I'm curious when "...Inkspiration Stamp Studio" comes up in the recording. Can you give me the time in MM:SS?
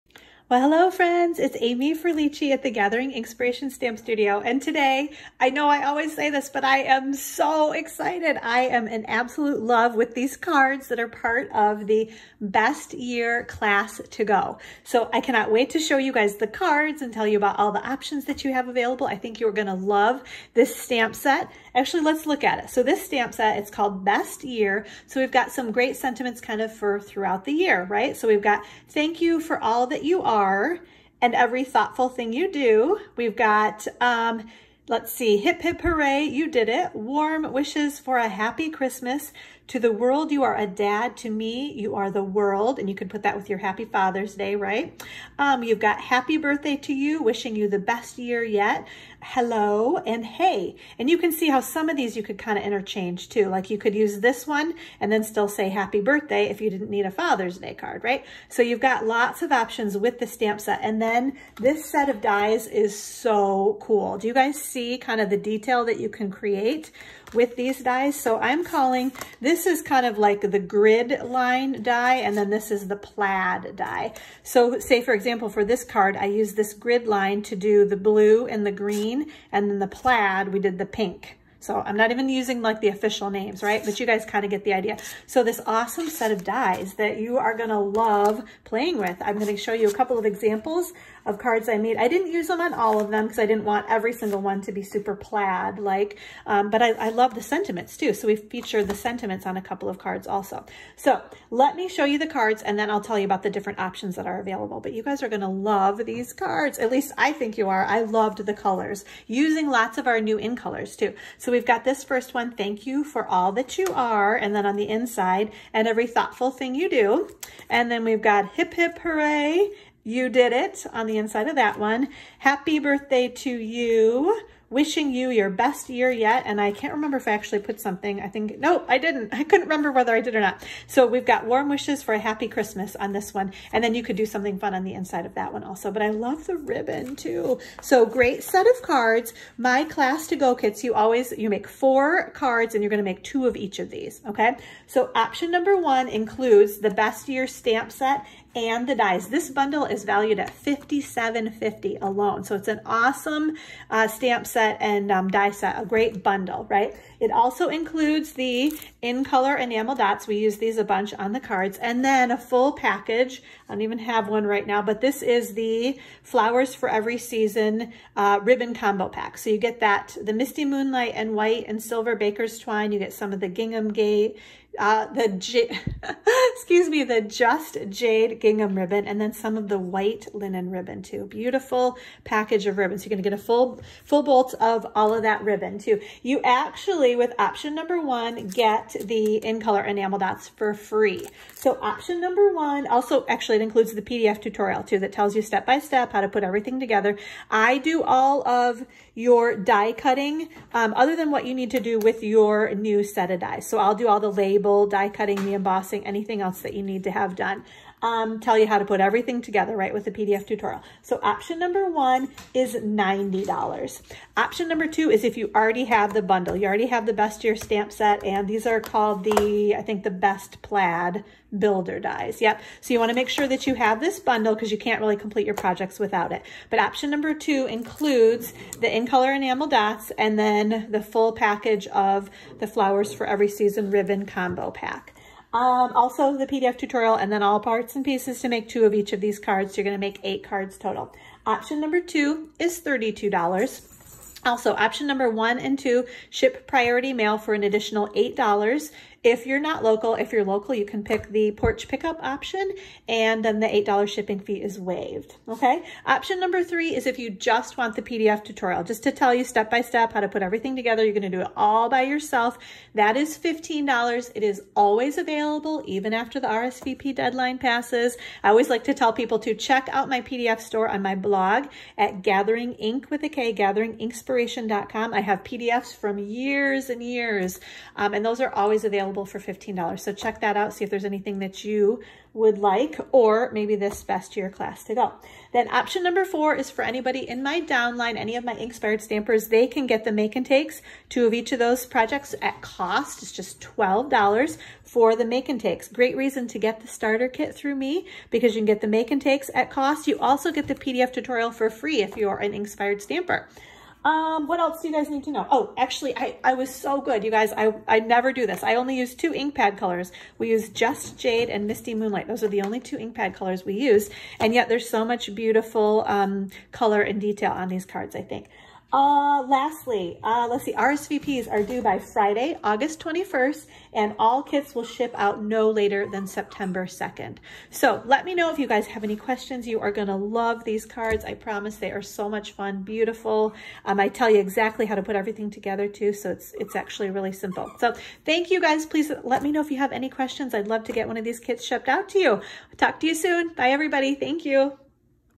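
00:03.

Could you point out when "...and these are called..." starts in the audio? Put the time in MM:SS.
03:38.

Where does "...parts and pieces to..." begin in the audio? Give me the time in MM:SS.
03:57.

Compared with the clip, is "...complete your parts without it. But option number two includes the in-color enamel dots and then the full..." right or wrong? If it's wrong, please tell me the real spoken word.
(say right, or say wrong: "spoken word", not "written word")
wrong: "projects", not "parts".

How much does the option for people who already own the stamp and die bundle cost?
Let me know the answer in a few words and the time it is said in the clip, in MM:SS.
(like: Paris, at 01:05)
$32, at 04:02.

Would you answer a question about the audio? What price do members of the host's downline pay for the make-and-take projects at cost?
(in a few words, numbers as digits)
$12.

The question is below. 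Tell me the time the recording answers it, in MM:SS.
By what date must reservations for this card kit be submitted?
05:21.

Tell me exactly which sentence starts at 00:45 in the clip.
Um, you've got happy birthday to you, wishing you the best year yet.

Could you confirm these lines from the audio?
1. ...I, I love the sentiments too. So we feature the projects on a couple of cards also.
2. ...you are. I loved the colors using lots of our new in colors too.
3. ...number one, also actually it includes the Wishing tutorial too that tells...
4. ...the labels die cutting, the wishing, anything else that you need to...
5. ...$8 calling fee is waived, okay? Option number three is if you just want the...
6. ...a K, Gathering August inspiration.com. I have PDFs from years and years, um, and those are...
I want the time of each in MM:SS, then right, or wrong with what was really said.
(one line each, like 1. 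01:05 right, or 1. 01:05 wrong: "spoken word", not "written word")
1. 01:36 wrong: "sentiments", not "projects"
2. 01:47 right
3. 03:12 wrong: "PDF", not "Wishing"
4. 03:24 wrong: "embossing", not "wishing"
5. 04:13 wrong: "shipping", not "calling"
6. 04:33 wrong: "Inksp", not "August".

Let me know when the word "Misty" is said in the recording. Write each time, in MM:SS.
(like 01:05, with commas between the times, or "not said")
02:50, 05:11.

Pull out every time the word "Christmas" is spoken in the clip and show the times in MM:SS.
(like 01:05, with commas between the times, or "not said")
00:38, 02:12.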